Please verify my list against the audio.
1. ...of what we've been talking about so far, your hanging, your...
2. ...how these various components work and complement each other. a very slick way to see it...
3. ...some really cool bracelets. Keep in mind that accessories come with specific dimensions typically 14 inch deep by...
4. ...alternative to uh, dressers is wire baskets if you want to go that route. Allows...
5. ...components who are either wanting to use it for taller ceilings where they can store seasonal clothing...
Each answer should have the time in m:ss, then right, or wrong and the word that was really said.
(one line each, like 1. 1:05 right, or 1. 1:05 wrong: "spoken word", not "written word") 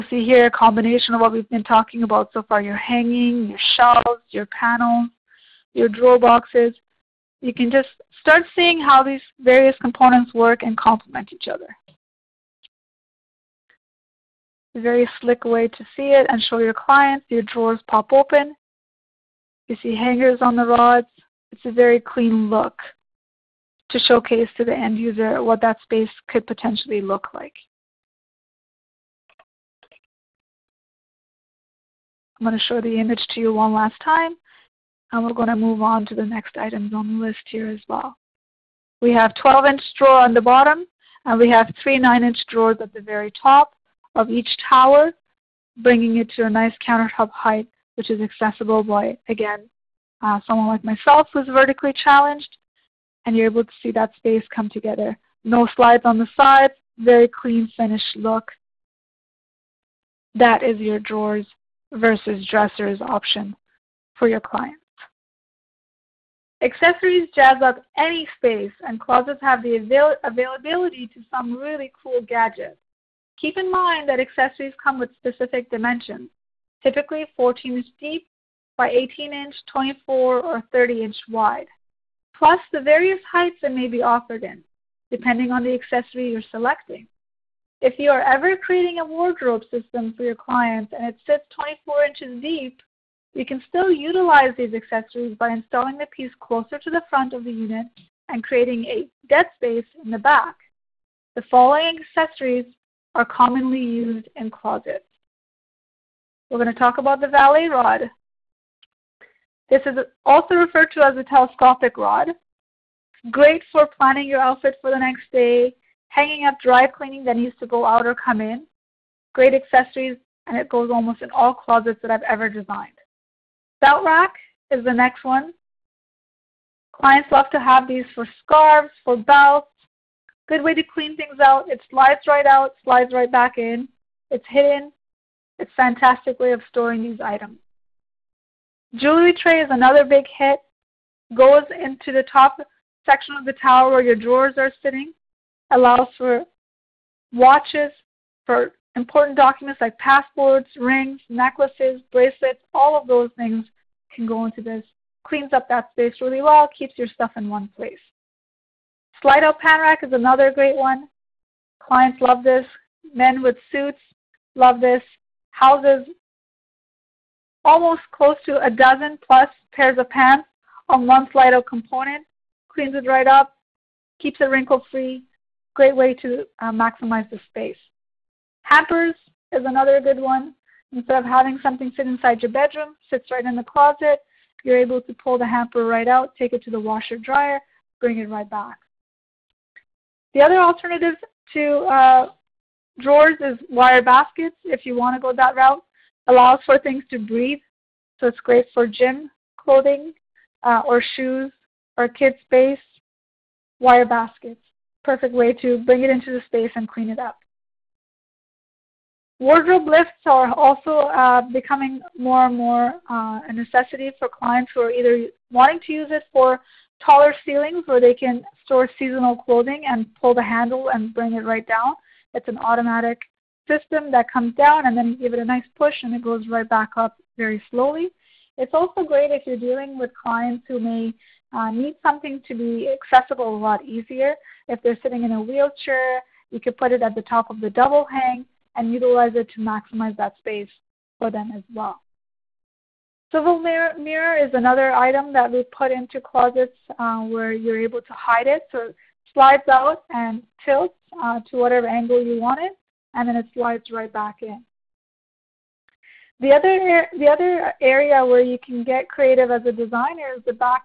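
1. 0:01 right
2. 0:08 right
3. 1:11 wrong: "gadgets", not "bracelets"
4. 3:10 wrong: "drawers", not "dressers"
5. 3:34 wrong: "clients", not "components".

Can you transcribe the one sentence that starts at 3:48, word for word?
It's also great if you're dealing with clients who may uh, need something to be accessible a lot easier.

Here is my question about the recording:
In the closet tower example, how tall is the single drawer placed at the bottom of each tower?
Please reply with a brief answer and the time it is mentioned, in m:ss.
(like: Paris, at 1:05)
12 inches, at 0:39.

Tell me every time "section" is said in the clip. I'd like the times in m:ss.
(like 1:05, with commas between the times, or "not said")
2:23.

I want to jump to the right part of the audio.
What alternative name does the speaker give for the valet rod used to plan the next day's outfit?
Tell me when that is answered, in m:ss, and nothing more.
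1:51.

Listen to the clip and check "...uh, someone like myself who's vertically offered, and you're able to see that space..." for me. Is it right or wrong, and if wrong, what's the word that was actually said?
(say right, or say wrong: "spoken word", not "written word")
wrong: "challenged", not "offered".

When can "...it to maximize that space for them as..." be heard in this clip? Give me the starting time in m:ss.
3:59.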